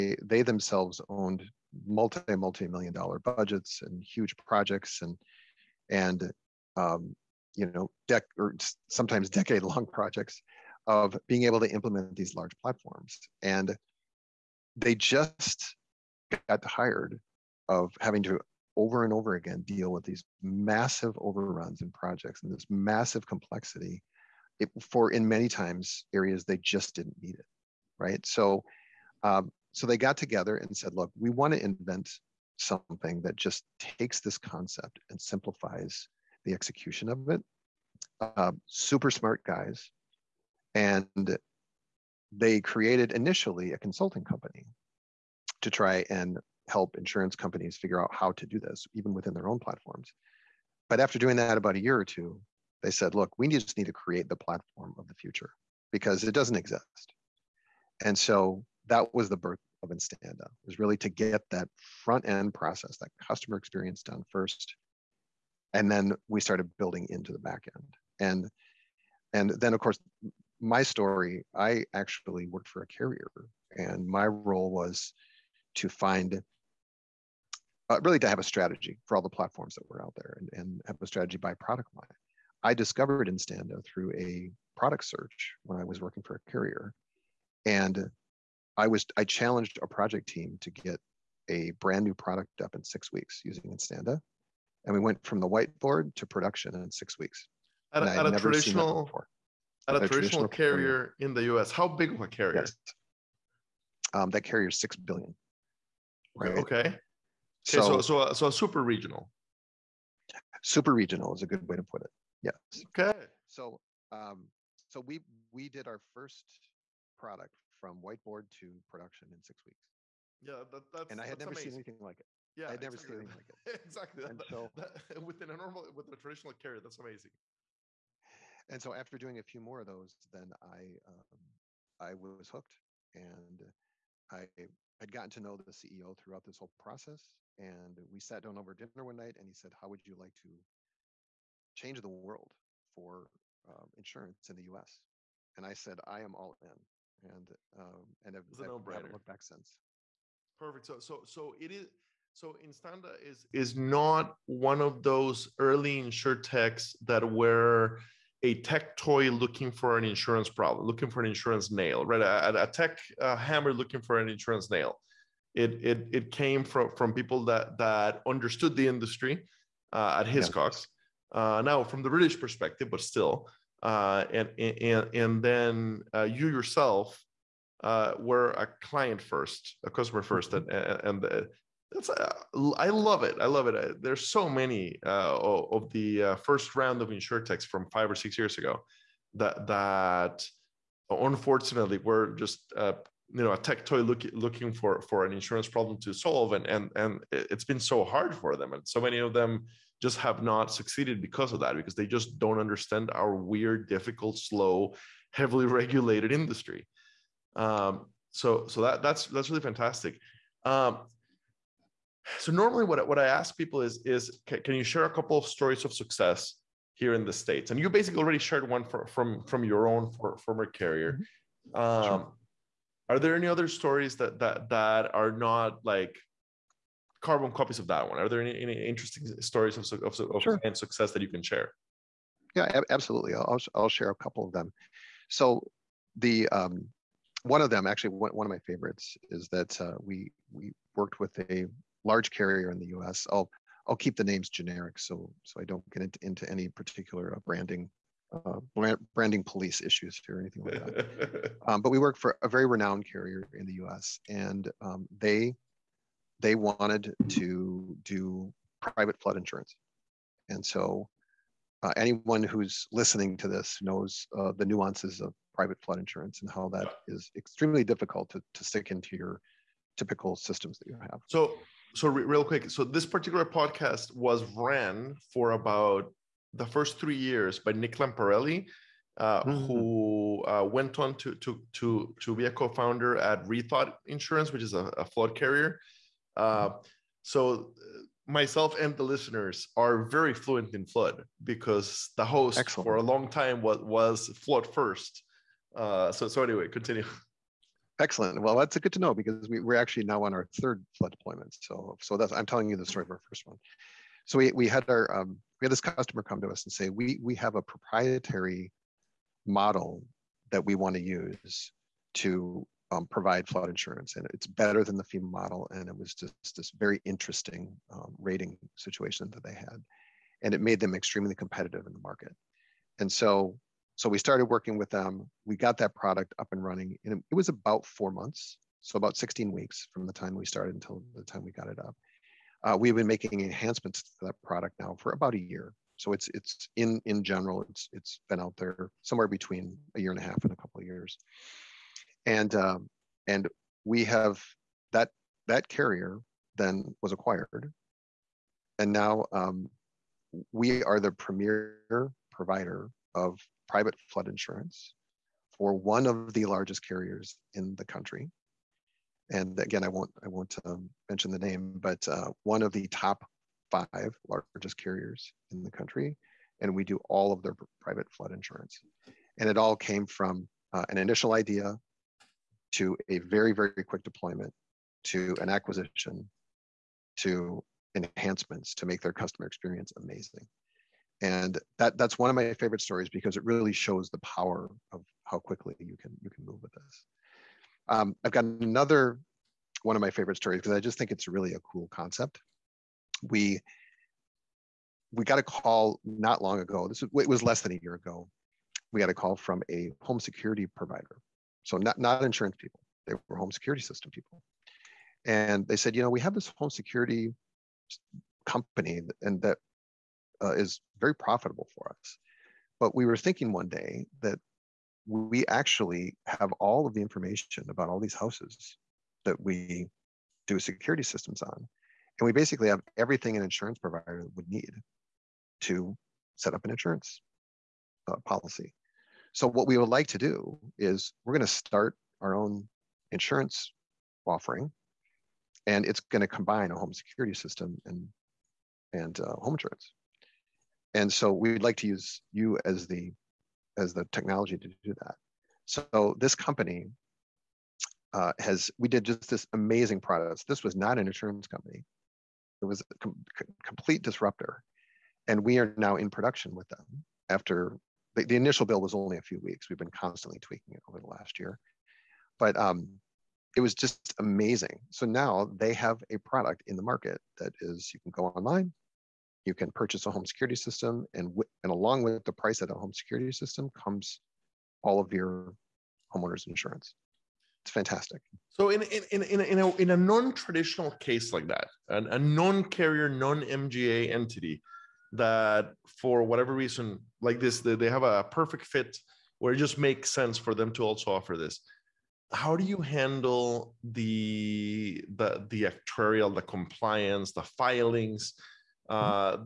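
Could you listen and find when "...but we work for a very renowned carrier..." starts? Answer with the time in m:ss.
4:11.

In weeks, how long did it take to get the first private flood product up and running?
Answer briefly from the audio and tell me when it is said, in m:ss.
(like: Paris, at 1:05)
16 weeks, at 5:29.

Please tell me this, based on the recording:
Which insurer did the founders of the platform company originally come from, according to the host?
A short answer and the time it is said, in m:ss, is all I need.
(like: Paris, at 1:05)
Hiscox, at 2:50.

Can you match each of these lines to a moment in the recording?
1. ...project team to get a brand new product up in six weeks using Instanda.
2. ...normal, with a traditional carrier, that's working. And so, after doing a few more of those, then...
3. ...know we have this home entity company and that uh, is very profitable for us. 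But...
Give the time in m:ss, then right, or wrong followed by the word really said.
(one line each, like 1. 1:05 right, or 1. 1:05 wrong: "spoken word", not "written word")
1. 1:29 right
2. 2:05 wrong: "amazing", not "working"
3. 6:46 wrong: "security", not "entity".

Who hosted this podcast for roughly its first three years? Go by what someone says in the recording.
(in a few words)
Nick Lamparelli.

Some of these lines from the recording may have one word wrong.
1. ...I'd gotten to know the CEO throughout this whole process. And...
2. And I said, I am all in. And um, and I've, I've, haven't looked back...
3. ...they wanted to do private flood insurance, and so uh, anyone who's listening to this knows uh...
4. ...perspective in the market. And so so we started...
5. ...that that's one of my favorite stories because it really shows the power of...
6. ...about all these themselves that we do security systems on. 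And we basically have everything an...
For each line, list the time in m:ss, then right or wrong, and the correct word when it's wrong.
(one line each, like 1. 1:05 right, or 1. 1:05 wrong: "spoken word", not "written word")
1. 2:15 right
2. 2:25 right
3. 4:16 right
4. 5:21 wrong: "competitive", not "perspective"
5. 6:21 right
6. 6:57 wrong: "houses", not "themselves".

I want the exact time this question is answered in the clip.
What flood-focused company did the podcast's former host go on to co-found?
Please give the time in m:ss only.
4:43.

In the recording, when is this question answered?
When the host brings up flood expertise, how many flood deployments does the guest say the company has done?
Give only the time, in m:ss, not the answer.
5:00.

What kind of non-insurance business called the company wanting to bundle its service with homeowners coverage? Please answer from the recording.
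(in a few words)
Home security provider.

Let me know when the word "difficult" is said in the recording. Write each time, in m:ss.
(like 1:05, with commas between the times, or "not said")
3:23, 4:27.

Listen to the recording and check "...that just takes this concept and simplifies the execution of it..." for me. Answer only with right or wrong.
right.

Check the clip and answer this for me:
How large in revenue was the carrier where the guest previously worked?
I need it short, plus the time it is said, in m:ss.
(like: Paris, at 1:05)
6 billion, at 1:44.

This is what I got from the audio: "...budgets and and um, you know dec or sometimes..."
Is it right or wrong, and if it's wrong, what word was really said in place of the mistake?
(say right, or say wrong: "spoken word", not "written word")
wrong: "projects", not "budgets".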